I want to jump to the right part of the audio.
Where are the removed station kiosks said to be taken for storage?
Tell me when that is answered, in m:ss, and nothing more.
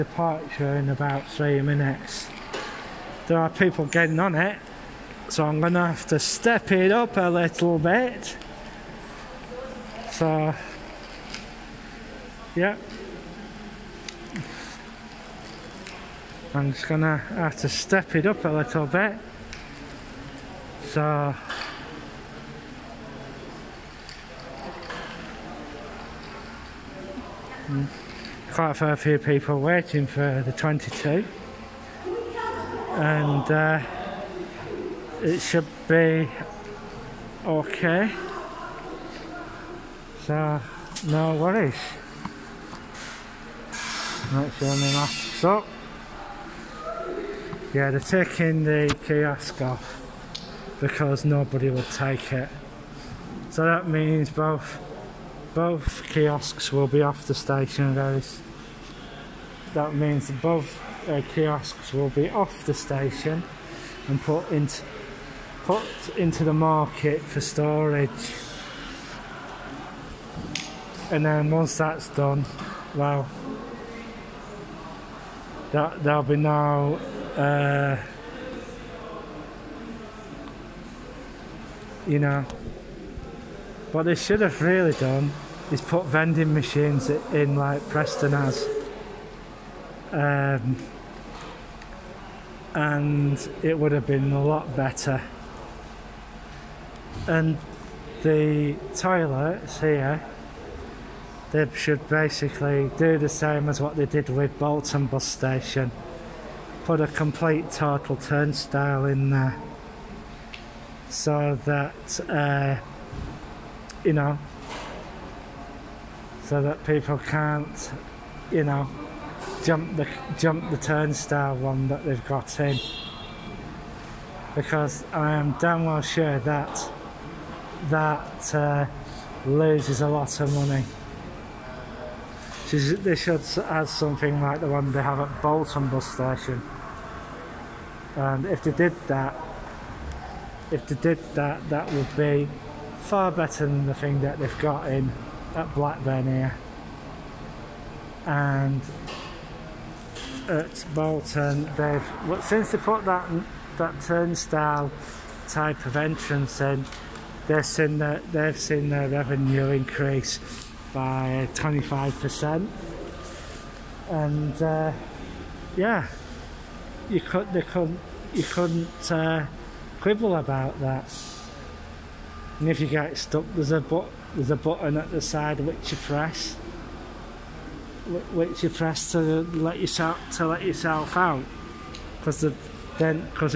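1:06.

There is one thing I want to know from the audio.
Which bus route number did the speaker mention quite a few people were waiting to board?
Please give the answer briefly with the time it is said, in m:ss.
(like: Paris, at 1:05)
22, at 0:30.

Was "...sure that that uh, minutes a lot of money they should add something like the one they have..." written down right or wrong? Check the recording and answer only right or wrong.
wrong.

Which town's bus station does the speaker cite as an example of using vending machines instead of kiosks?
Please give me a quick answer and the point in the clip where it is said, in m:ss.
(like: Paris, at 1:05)
Preston, at 1:27.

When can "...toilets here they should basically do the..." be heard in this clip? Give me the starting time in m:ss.
1:38.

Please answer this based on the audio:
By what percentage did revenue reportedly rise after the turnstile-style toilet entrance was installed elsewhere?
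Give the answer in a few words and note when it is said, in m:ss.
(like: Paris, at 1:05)
25%, at 2:41.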